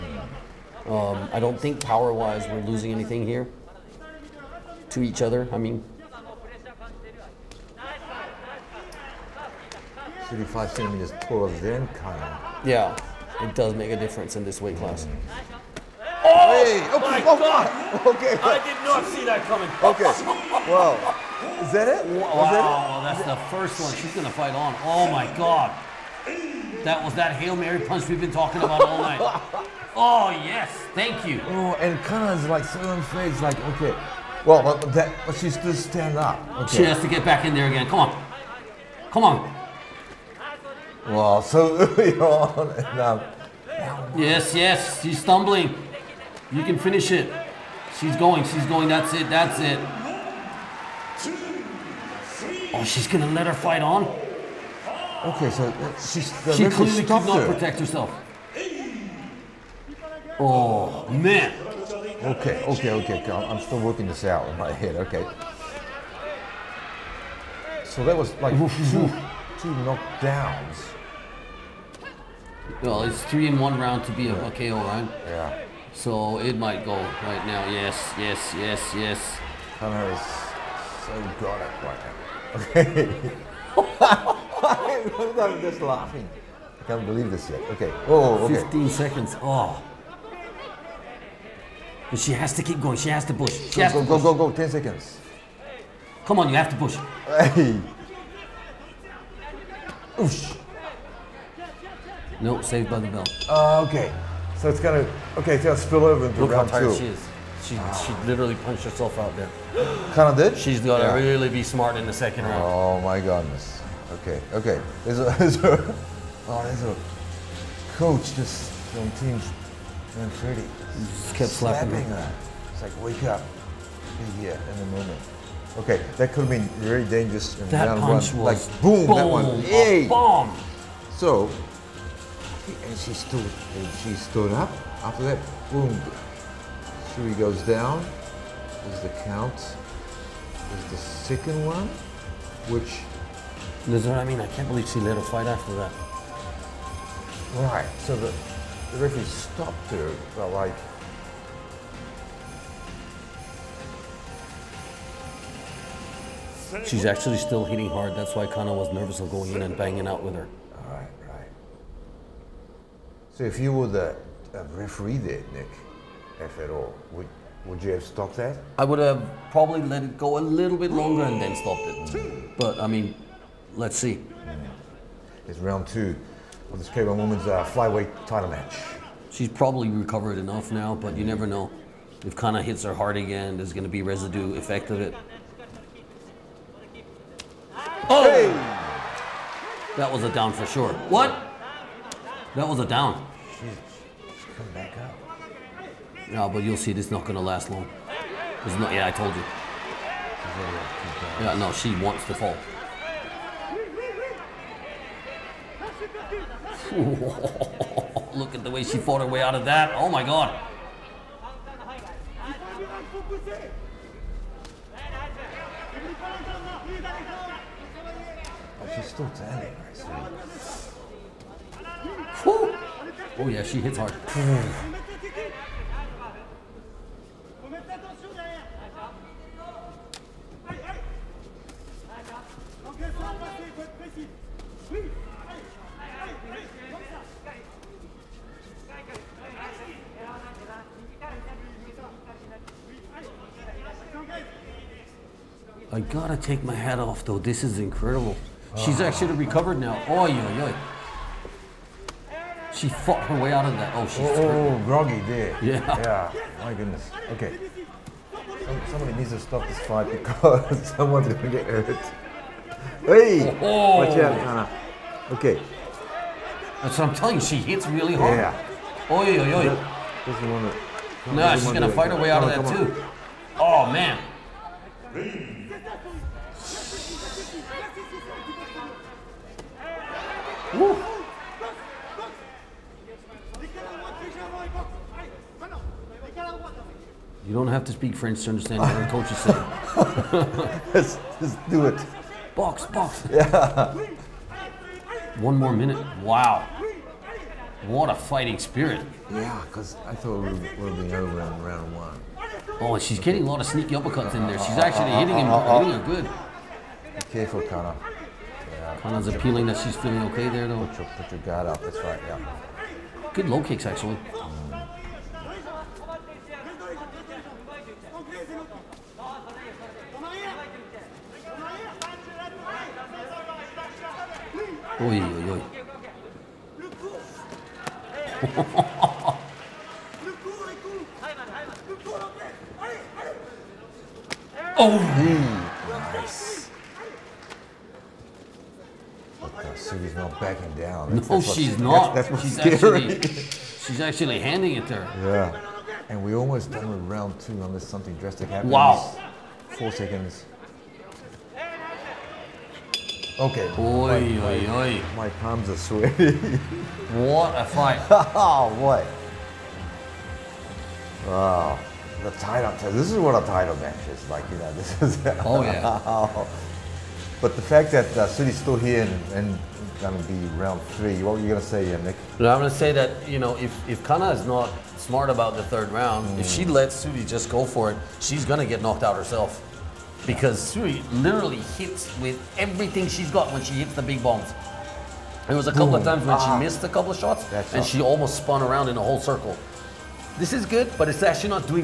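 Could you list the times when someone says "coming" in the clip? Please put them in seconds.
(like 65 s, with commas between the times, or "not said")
19 s.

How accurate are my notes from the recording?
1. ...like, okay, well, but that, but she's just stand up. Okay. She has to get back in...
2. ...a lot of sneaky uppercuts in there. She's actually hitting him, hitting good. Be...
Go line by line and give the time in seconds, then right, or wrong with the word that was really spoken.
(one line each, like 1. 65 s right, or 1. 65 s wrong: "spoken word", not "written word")
1. 33 s right
2. 303 s right.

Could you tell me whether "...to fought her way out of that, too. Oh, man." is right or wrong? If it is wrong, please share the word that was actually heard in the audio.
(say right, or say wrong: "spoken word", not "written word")
wrong: "fight", not "fought".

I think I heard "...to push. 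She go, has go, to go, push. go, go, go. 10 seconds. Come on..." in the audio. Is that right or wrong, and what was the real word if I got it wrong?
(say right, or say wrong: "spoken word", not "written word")
right.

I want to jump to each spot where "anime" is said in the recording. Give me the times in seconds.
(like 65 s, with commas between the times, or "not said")
not said.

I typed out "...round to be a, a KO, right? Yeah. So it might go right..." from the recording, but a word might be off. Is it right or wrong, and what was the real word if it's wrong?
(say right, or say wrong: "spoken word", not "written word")
right.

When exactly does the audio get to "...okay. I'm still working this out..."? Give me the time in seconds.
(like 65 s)
62 s.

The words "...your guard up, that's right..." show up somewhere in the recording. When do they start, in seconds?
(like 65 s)
311 s.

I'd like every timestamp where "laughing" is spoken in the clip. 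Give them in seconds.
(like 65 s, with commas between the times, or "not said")
85 s.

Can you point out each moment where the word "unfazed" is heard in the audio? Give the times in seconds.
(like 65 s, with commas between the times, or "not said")
32 s.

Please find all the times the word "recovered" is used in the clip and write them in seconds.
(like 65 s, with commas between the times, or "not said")
179 s, 249 s.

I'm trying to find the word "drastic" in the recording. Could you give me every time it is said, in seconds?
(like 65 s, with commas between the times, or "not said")
348 s.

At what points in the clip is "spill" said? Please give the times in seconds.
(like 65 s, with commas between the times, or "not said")
105 s.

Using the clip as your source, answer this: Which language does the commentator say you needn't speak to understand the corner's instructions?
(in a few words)
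French.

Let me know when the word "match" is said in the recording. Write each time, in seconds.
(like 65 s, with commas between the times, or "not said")
178 s, 363 s.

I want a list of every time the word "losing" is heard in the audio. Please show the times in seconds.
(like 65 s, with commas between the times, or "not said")
2 s.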